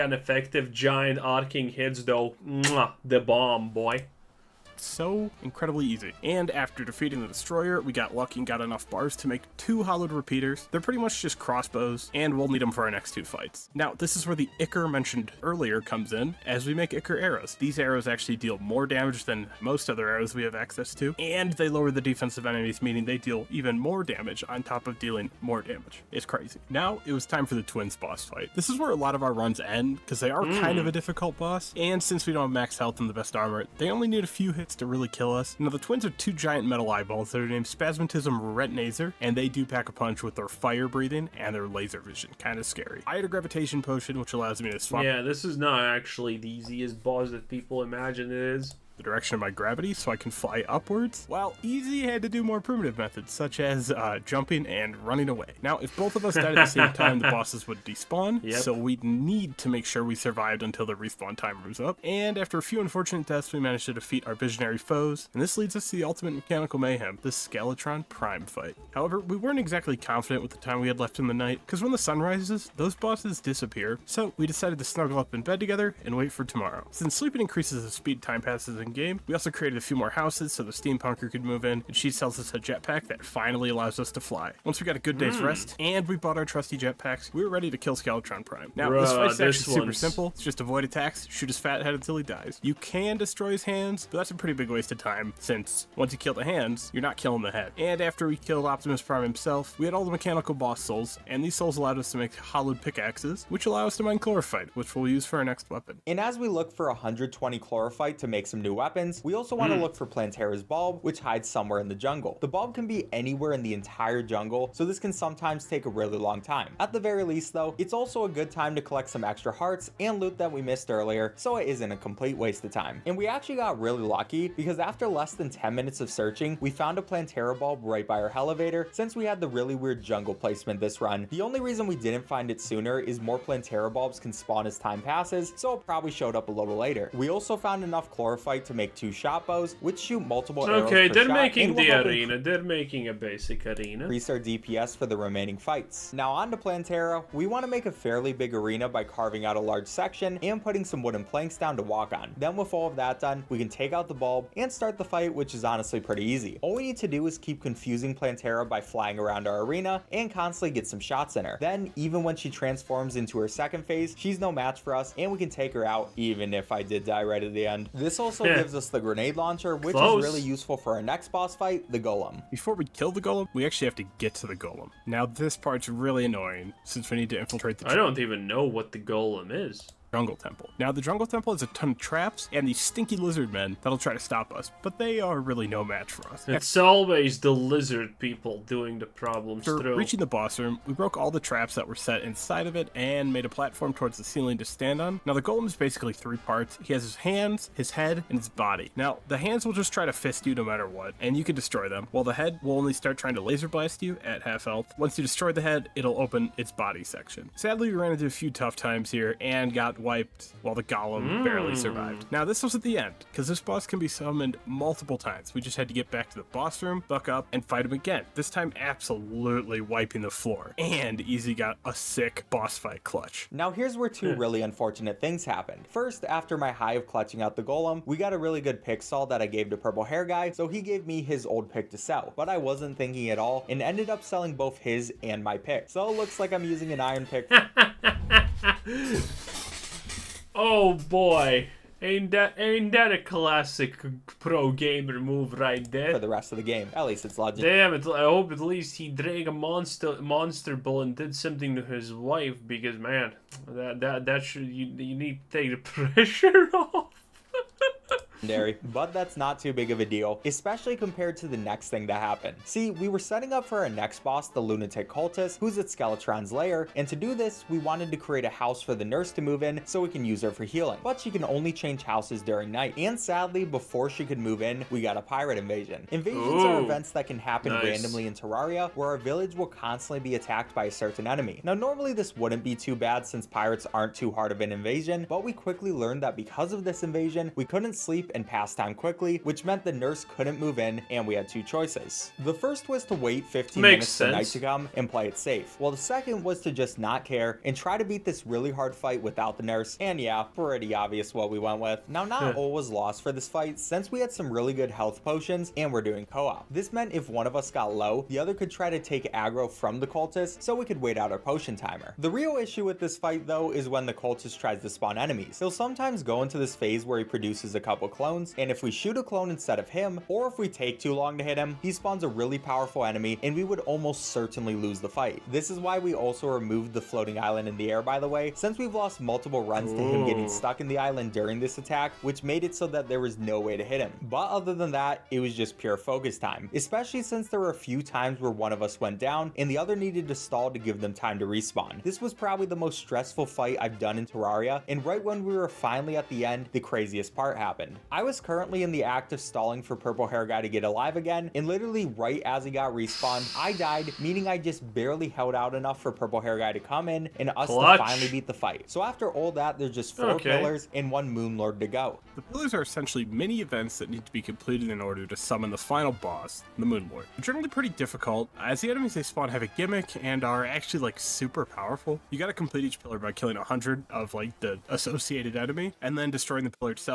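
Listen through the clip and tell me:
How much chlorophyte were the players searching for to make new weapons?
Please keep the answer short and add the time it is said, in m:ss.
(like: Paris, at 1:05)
120, at 1:46.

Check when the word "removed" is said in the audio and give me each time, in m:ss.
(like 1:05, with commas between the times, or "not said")
5:26.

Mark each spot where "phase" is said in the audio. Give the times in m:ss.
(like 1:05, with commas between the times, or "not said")
2:43, 5:16.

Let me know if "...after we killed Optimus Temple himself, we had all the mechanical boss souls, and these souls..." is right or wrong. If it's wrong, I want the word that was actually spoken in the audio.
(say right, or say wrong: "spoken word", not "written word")
wrong: "Prime", not "Temple".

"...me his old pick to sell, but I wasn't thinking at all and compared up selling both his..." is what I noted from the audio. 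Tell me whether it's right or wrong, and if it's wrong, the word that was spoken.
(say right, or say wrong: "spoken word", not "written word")
wrong: "ended", not "compared".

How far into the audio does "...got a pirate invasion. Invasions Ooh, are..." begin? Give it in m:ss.
4:35.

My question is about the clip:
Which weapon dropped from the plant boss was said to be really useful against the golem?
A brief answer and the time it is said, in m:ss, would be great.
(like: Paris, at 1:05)
grenade launcher, at 2:49.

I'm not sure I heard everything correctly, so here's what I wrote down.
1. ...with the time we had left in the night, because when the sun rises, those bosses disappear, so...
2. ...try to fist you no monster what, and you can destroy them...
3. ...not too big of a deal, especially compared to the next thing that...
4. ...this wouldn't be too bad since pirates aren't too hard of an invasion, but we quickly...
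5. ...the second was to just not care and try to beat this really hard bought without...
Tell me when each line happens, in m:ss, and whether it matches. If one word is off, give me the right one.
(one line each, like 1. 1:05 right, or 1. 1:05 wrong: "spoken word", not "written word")
1. 1:10 right
2. 3:19 wrong: "matter", not "monster"
3. 4:19 right
4. 4:42 right
5. 4:55 wrong: "fight", not "bought".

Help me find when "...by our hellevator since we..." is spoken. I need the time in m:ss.
2:08.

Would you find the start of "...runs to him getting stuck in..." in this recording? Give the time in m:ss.
5:29.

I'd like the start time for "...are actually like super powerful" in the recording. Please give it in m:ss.
6:10.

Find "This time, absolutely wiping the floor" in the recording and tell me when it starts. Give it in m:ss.
3:38.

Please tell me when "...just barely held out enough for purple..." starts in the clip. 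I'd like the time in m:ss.
5:54.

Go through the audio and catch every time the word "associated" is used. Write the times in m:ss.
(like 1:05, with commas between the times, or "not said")
6:14.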